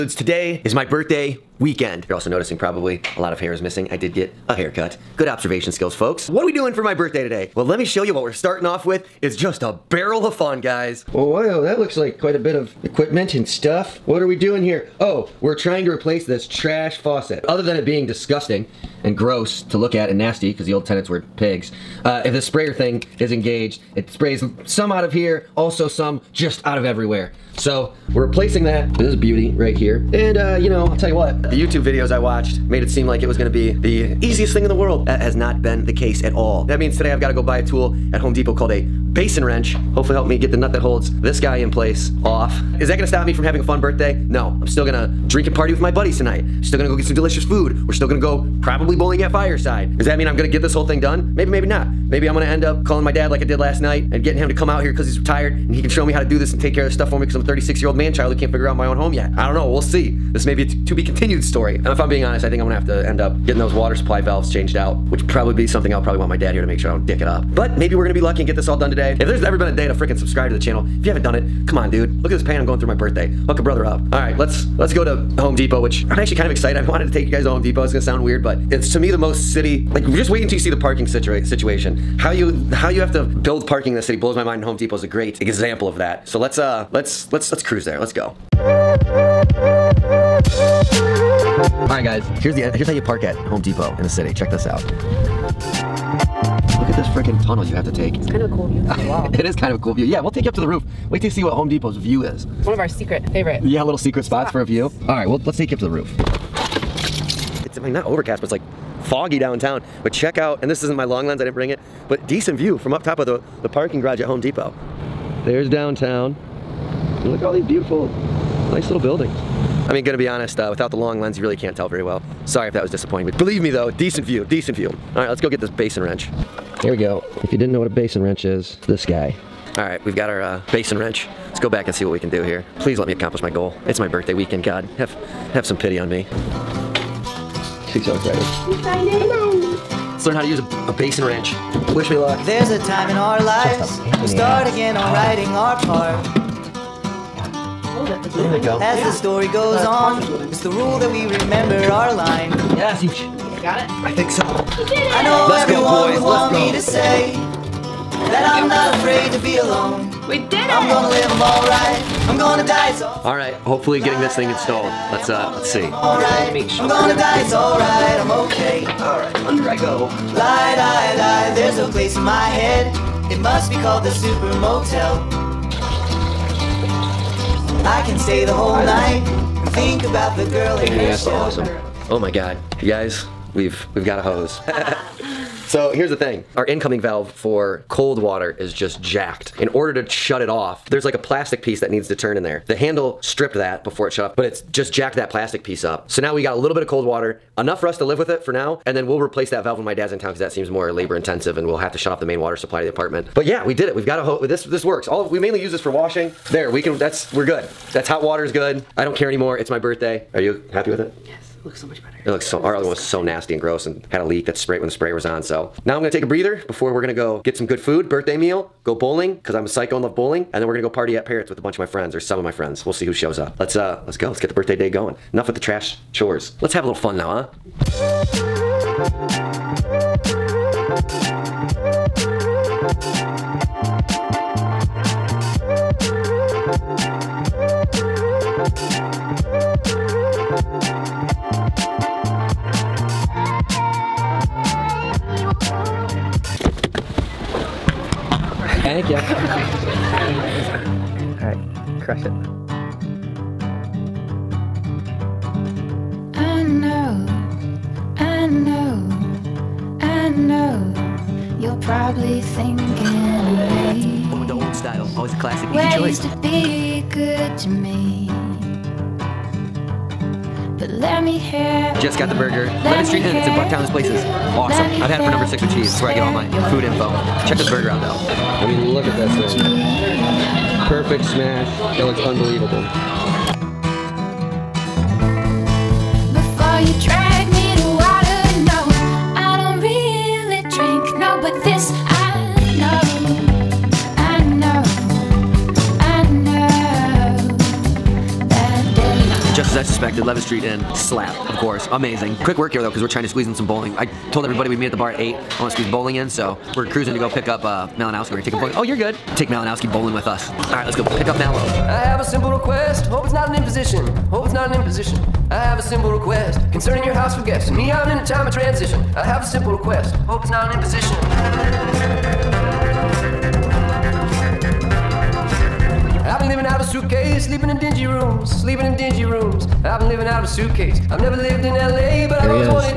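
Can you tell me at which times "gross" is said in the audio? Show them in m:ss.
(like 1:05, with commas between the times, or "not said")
0:19, 3:33.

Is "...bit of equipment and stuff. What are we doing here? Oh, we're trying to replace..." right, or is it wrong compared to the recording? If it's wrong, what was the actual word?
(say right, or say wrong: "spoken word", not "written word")
right.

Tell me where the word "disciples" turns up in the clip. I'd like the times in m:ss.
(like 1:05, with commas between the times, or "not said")
not said.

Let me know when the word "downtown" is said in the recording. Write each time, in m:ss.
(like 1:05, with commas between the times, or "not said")
1:49, 1:55.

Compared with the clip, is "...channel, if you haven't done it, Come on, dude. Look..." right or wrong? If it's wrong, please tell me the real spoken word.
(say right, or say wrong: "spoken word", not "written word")
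right.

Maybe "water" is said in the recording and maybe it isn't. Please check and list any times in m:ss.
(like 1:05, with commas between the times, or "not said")
1:03, 3:08, 3:17, 3:22, 3:28.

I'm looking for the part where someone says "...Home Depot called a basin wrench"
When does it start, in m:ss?
0:38.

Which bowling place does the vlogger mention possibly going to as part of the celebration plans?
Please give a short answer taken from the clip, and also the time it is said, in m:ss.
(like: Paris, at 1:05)
Fireside, at 0:49.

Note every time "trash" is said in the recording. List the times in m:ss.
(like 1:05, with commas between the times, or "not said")
0:16, 3:45.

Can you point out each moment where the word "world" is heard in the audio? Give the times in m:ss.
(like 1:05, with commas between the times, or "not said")
0:34.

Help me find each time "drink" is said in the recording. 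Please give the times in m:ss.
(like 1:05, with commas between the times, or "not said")
0:45.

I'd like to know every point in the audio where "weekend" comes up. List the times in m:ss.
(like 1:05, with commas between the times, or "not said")
0:01, 2:14.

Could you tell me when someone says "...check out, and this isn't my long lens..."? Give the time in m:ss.
1:50.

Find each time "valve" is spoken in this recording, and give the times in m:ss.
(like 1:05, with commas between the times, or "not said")
1:04, 3:07, 3:19.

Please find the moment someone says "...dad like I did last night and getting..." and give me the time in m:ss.
0:53.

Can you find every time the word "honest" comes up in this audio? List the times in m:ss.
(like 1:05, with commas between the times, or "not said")
1:02, 2:00.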